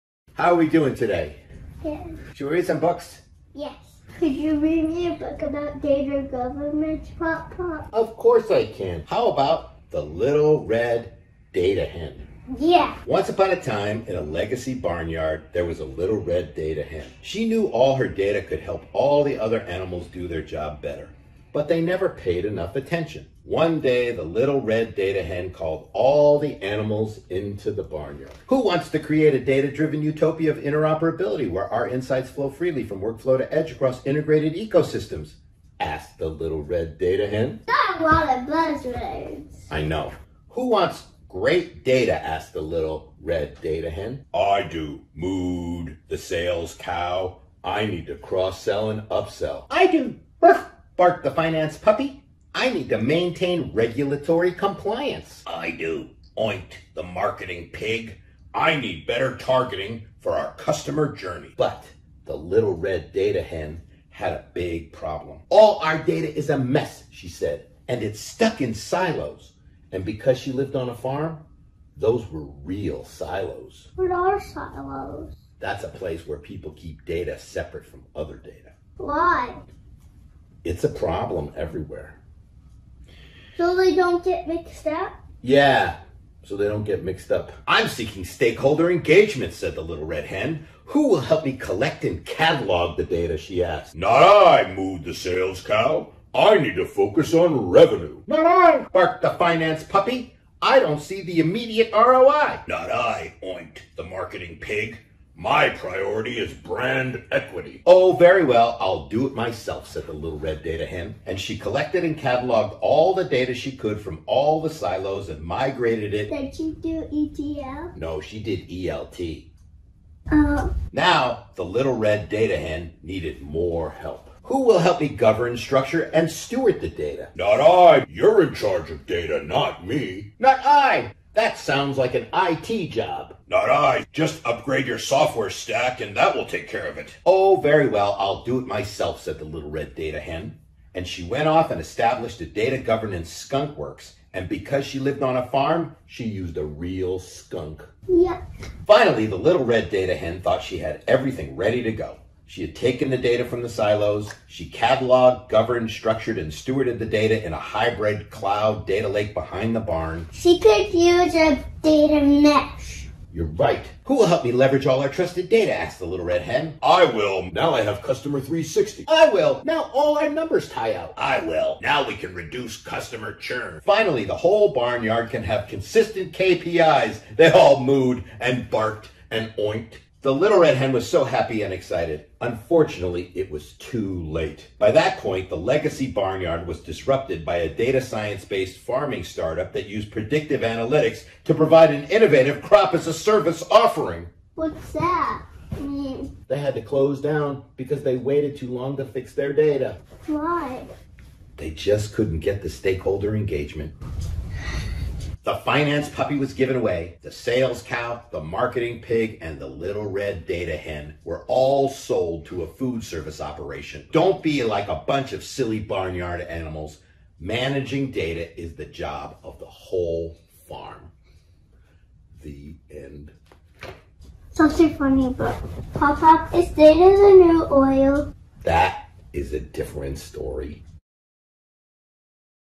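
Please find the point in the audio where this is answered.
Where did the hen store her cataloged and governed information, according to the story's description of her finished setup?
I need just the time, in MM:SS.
02:37.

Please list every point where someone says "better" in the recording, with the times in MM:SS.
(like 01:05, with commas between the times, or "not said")
00:20, 00:59.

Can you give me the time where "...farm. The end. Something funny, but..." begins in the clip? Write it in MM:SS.
03:40.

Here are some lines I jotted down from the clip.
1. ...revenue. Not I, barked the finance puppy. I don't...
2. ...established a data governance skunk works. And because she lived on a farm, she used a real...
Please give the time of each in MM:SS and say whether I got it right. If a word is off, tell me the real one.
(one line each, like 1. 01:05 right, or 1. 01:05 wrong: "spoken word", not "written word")
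1. 01:37 right
2. 02:21 right.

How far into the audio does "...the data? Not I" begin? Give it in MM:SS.
02:06.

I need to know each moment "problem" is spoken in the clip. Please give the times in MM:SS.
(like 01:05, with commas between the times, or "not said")
01:04, 01:20.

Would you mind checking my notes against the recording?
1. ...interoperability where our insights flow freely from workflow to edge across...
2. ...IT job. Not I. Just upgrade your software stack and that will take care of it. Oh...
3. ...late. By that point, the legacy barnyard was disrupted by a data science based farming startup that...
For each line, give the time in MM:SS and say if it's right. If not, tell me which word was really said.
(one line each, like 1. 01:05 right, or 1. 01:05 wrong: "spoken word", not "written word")
1. 00:30 right
2. 02:12 right
3. 03:04 right.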